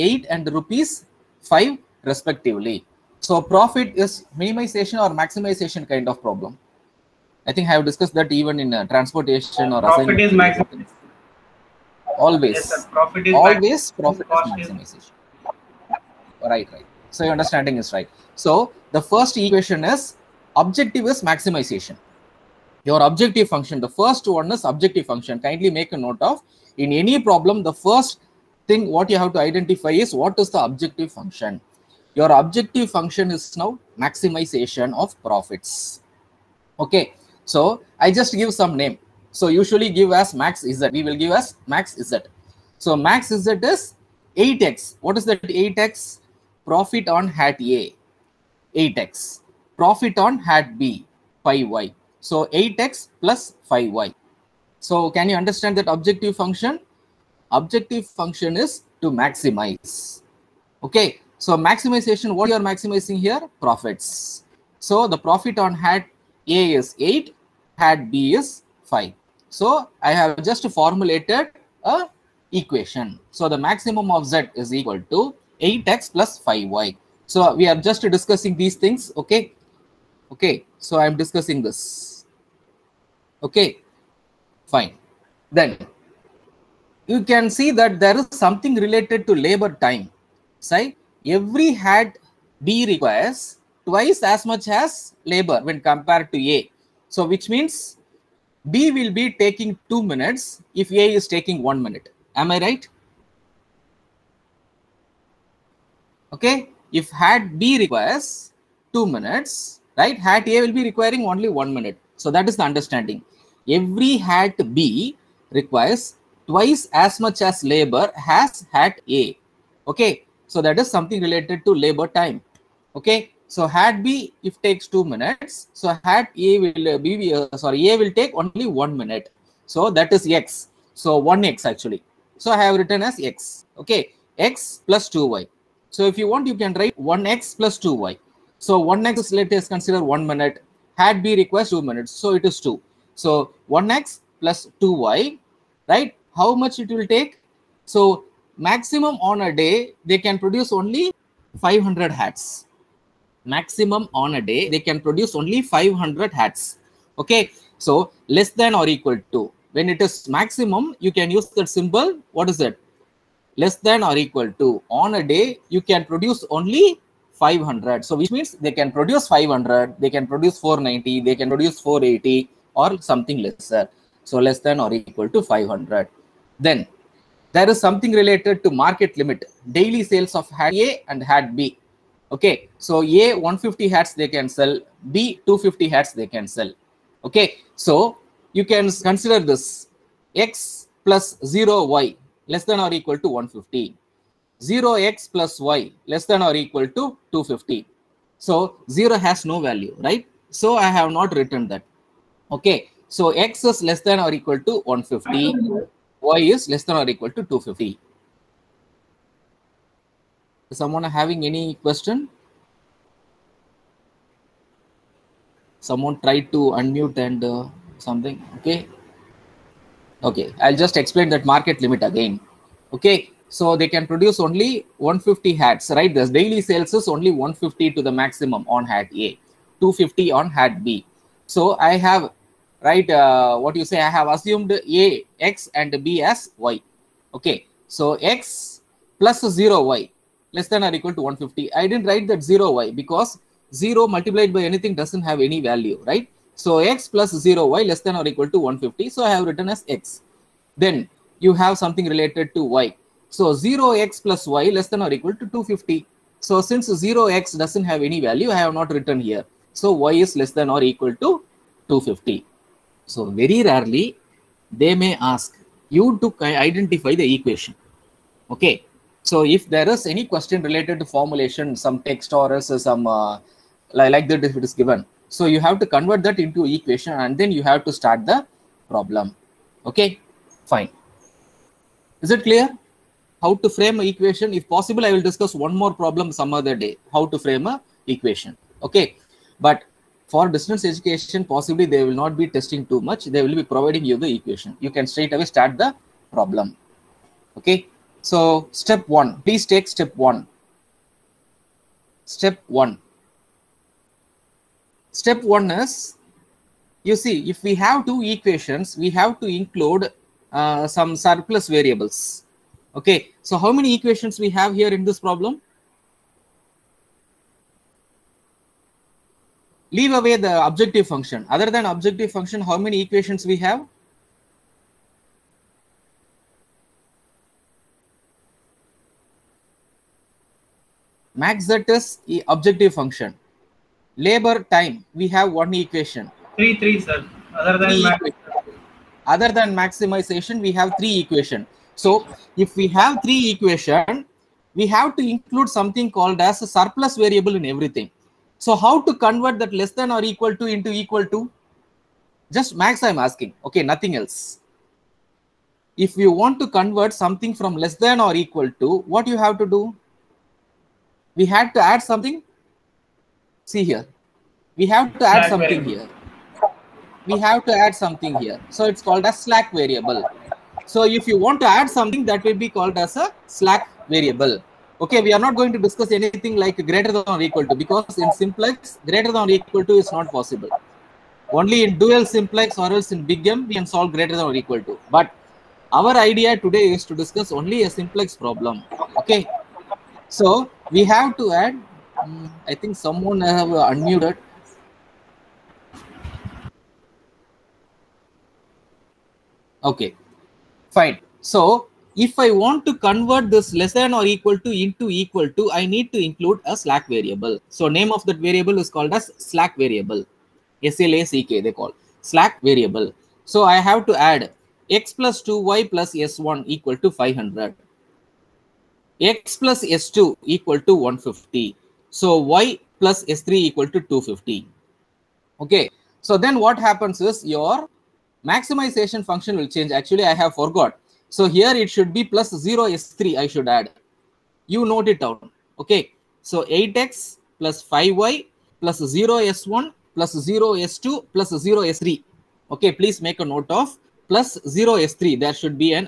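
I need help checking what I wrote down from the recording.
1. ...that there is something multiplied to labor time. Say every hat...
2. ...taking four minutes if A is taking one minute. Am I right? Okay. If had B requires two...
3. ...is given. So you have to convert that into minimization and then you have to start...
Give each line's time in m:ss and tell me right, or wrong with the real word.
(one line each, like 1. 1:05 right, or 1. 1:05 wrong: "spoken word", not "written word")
1. 1:27 wrong: "related", not "multiplied"
2. 1:39 wrong: "two", not "four"
3. 4:34 wrong: "equation", not "minimization".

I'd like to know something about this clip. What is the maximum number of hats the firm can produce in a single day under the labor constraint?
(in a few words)
500.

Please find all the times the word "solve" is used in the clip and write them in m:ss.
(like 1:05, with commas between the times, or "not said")
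6:23.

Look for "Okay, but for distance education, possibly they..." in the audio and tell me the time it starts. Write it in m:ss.
4:48.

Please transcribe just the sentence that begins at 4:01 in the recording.
I didn't write that 0y because 0 multiplied by anything doesn't have any value, right?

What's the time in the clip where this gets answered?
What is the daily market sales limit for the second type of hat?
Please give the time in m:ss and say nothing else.
3:05.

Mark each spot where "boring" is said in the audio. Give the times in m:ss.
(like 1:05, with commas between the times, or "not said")
not said.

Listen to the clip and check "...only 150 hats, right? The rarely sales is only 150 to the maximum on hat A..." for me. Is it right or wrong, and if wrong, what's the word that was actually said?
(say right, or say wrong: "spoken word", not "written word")
wrong: "daily", not "rarely".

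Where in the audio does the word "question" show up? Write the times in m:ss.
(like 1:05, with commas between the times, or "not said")
3:31, 4:30.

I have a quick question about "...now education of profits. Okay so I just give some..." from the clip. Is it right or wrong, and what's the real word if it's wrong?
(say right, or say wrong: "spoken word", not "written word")
wrong: "maximization", not "education".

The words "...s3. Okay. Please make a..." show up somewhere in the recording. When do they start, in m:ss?
7:21.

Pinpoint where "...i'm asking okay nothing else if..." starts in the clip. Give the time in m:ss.
5:53.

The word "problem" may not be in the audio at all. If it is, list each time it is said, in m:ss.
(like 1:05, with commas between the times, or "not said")
0:06, 0:27, 4:38, 4:45, 4:56, 5:15, 6:28.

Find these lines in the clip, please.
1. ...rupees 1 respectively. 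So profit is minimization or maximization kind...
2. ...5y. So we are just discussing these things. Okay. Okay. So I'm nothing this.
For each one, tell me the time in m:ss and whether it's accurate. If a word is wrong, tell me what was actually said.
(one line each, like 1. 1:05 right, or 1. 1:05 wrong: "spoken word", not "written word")
1. 0:00 wrong: "5", not "1"
2. 1:16 wrong: "discussing", not "nothing".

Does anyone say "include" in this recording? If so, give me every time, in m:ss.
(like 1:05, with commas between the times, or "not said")
5:09, 5:45, 6:46.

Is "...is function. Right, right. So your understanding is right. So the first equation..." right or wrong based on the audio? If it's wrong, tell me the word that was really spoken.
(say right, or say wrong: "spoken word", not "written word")
wrong: "maximization", not "function".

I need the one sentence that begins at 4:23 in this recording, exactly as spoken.
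So very rarely they may ask you to identify the equation.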